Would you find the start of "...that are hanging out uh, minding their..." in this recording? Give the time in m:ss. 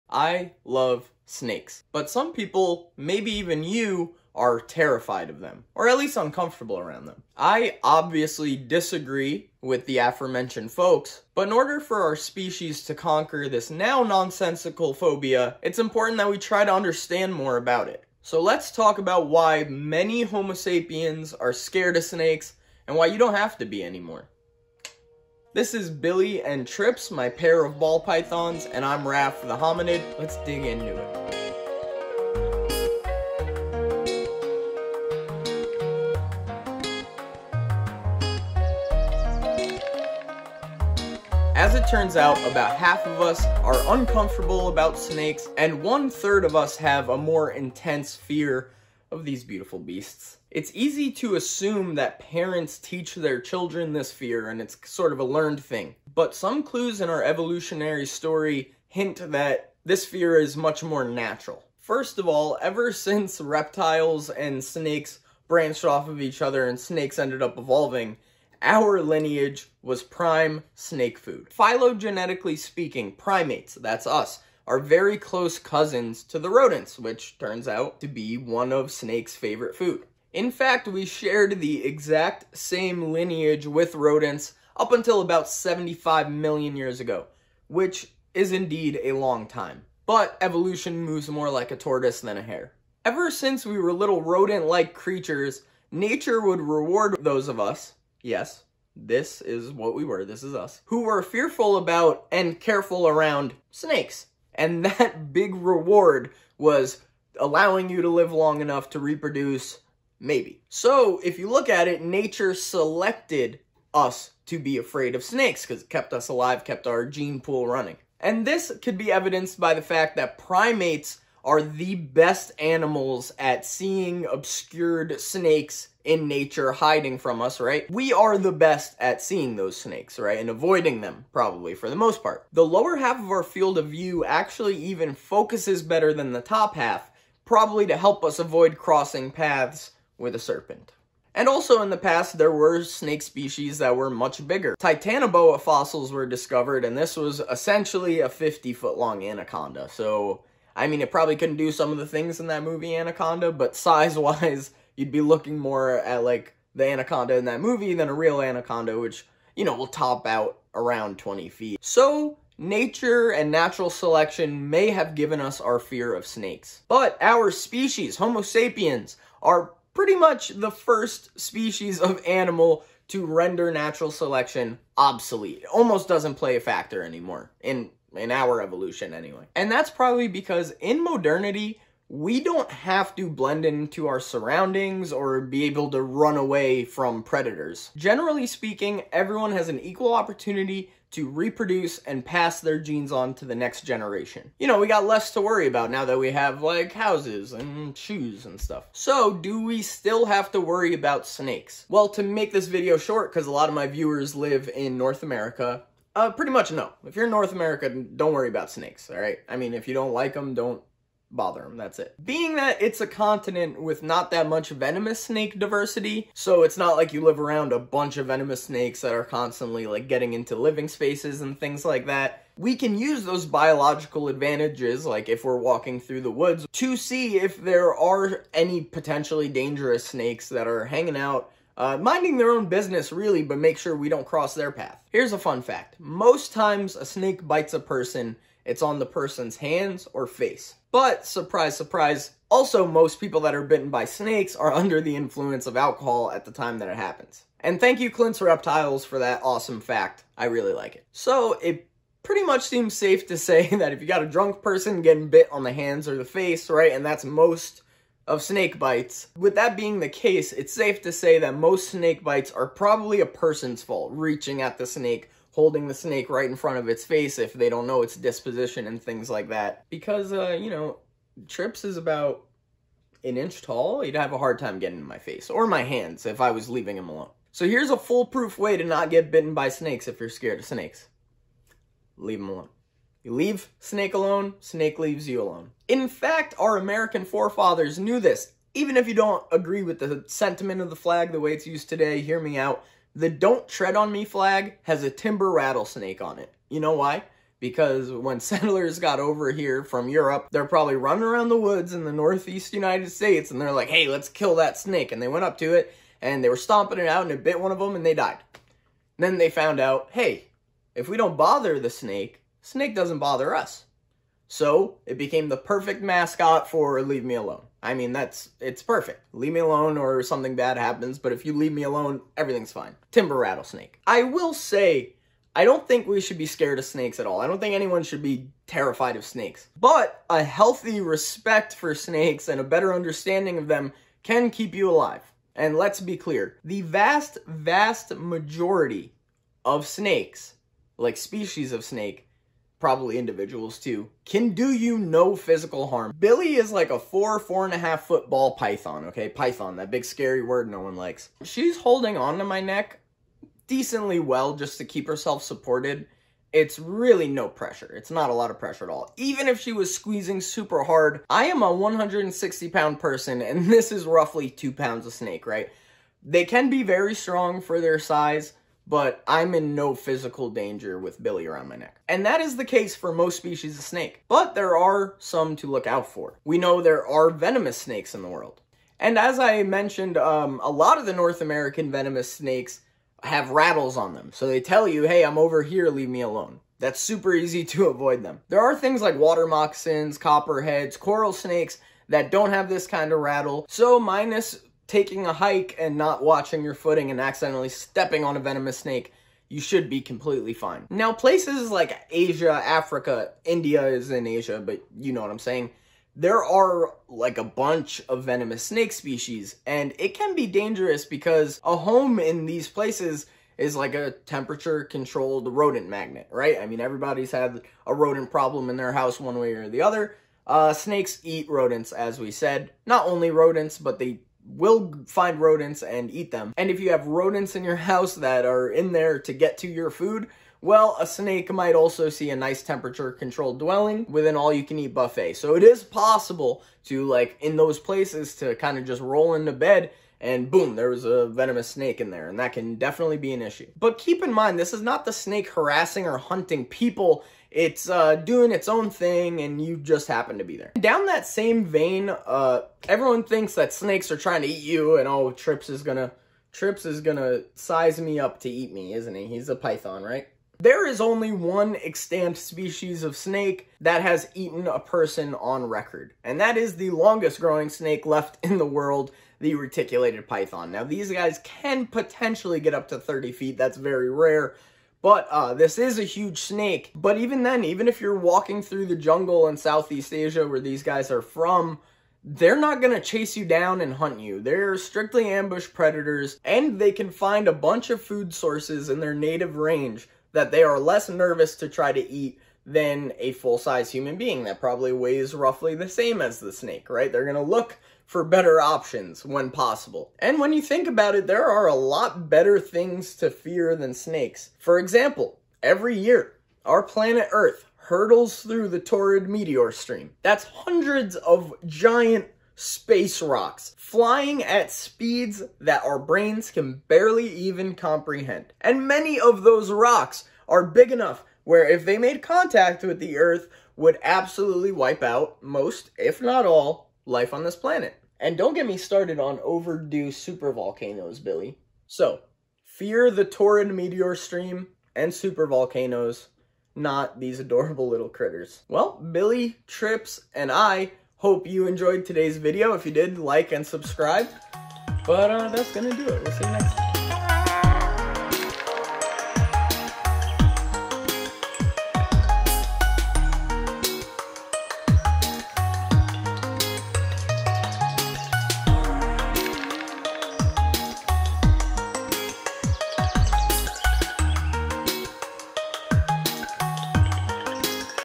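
3:50.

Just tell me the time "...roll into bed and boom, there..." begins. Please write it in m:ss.
7:19.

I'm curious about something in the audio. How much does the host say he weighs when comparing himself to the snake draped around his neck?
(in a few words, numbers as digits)
160 pounds.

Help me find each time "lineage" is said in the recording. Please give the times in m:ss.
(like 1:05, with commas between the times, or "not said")
1:09, 1:23.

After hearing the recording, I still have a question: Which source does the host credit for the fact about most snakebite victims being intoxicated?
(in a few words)
Clint's Reptiles.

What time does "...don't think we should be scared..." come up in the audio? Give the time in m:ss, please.
5:25.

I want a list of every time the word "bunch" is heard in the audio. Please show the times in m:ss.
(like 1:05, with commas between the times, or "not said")
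3:37, 6:47, 8:07.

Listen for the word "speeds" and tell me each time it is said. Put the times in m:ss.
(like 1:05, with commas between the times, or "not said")
8:34.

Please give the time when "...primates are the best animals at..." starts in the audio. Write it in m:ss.
2:00.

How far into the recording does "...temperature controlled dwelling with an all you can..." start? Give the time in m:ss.
7:12.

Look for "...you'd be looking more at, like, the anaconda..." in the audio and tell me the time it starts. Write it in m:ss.
2:34.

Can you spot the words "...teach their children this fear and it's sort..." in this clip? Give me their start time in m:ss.
0:52.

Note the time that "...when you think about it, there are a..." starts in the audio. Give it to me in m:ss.
8:20.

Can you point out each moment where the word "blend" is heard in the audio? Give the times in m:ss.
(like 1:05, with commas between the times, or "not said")
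3:03.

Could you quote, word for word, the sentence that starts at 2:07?
We are the best at seeing those snakes, right?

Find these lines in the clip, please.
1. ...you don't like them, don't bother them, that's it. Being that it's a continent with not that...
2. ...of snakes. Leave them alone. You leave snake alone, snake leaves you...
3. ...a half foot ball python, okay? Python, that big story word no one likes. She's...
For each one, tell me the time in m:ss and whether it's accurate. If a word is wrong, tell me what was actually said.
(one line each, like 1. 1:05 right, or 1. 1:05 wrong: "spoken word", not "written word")
1. 3:29 right
2. 4:40 right
3. 5:47 wrong: "scary", not "story".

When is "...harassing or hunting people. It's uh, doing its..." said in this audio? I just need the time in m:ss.
7:25.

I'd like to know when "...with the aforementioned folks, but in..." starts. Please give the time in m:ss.
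0:09.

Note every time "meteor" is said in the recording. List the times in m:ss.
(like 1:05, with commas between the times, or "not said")
8:29, 8:53.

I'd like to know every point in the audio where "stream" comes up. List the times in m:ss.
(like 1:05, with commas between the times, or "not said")
8:29, 8:54.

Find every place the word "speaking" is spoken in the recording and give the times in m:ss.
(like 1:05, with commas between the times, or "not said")
1:12, 3:08.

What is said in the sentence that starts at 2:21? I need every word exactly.
And also in the past, there were snake species that were much bigger.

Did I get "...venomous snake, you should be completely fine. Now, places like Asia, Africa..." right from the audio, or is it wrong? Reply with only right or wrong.
right.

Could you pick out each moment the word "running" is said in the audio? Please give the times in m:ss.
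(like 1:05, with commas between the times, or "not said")
1:57, 5:00.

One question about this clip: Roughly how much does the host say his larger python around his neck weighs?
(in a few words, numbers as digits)
2 pounds.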